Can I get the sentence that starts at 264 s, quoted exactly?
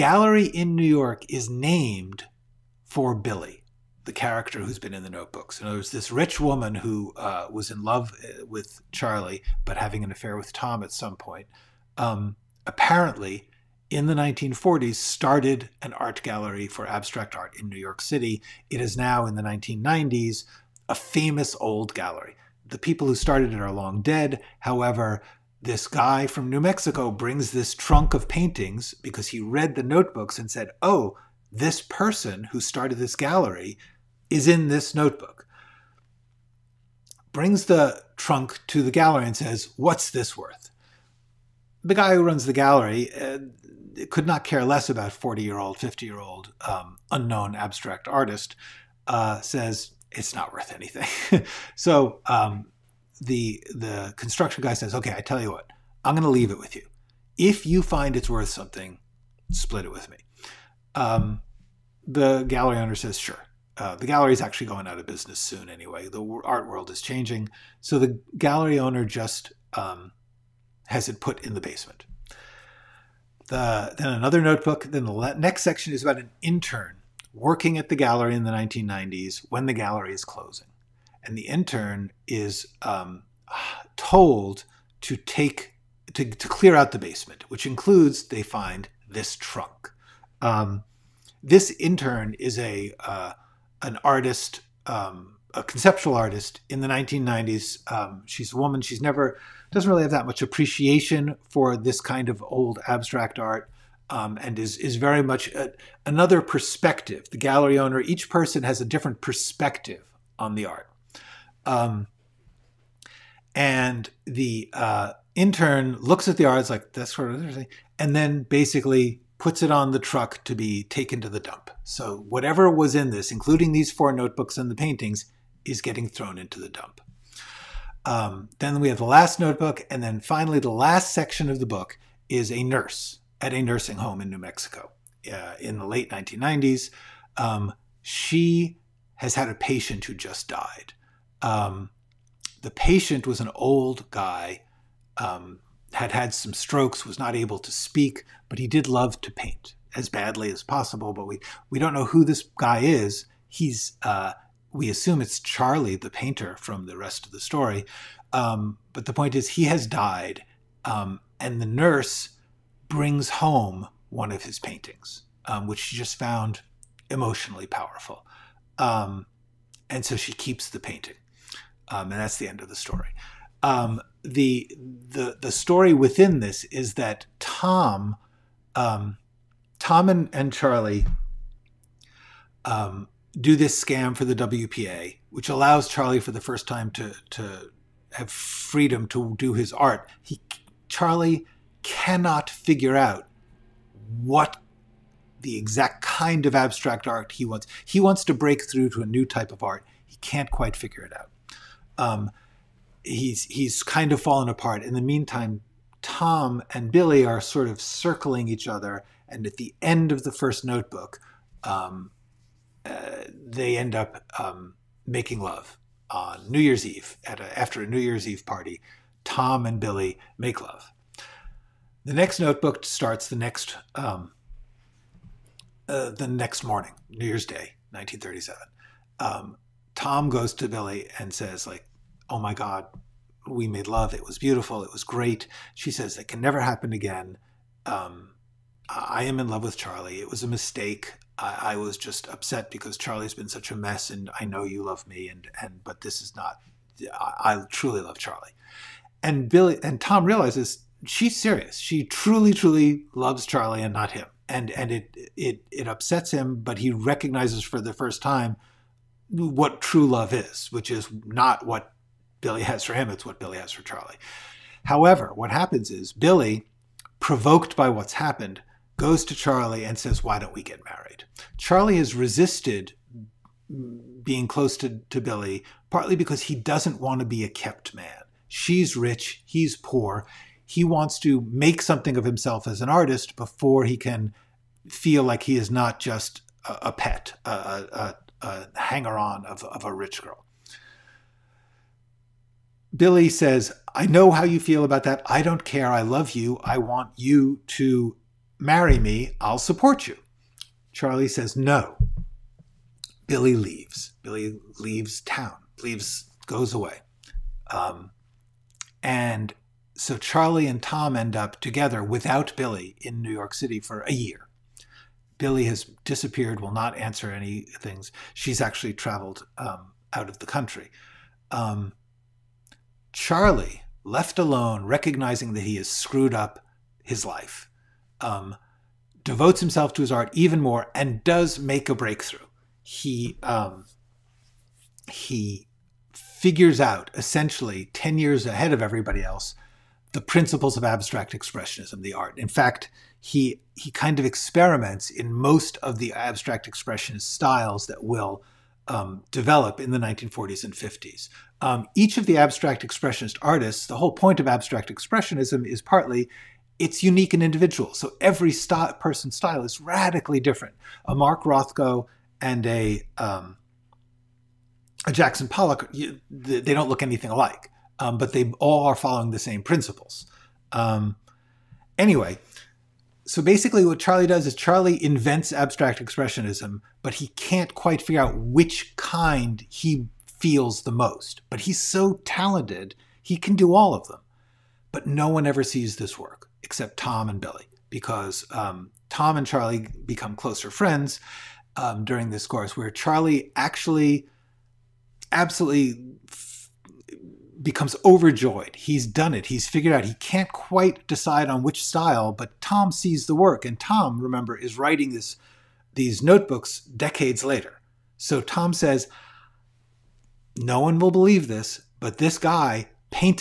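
However, what happens is Billy, provoked by what's happened, goes to Charlie and says, Why don't we get married?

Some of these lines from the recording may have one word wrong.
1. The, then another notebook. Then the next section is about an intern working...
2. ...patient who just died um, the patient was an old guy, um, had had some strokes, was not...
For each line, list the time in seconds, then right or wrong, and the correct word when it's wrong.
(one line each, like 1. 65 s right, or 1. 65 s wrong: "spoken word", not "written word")
1. 73 s right
2. 139 s right.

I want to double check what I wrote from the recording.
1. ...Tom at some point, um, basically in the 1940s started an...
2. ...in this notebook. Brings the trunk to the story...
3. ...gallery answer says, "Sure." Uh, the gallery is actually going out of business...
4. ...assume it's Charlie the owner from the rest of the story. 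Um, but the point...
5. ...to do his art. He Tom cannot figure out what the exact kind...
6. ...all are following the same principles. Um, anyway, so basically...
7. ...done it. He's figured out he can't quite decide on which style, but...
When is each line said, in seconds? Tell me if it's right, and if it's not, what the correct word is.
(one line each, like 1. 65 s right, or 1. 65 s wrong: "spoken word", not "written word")
1. 10 s wrong: "apparently", not "basically"
2. 34 s wrong: "gallery", not "story"
3. 62 s wrong: "owner", not "answer"
4. 154 s wrong: "painter", not "owner"
5. 189 s wrong: "Charlie", not "Tom"
6. 368 s right
7. 399 s right.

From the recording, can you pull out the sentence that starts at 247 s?
I, I truly love Charlie, and Billy and Tom realizes she's serious.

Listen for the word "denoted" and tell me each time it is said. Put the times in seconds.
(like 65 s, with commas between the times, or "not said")
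not said.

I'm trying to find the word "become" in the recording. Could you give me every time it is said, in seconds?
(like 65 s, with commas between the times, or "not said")
390 s, 397 s.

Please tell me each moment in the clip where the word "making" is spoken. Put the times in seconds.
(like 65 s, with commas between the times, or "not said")
215 s.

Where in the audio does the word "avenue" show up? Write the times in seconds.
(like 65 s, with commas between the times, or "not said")
not said.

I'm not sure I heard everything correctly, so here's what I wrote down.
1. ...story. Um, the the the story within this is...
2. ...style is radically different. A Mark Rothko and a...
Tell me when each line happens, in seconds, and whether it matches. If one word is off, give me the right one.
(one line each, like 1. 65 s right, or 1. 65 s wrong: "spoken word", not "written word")
1. 172 s right
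2. 359 s right.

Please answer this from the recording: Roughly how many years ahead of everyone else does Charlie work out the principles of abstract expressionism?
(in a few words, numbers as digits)
10 years.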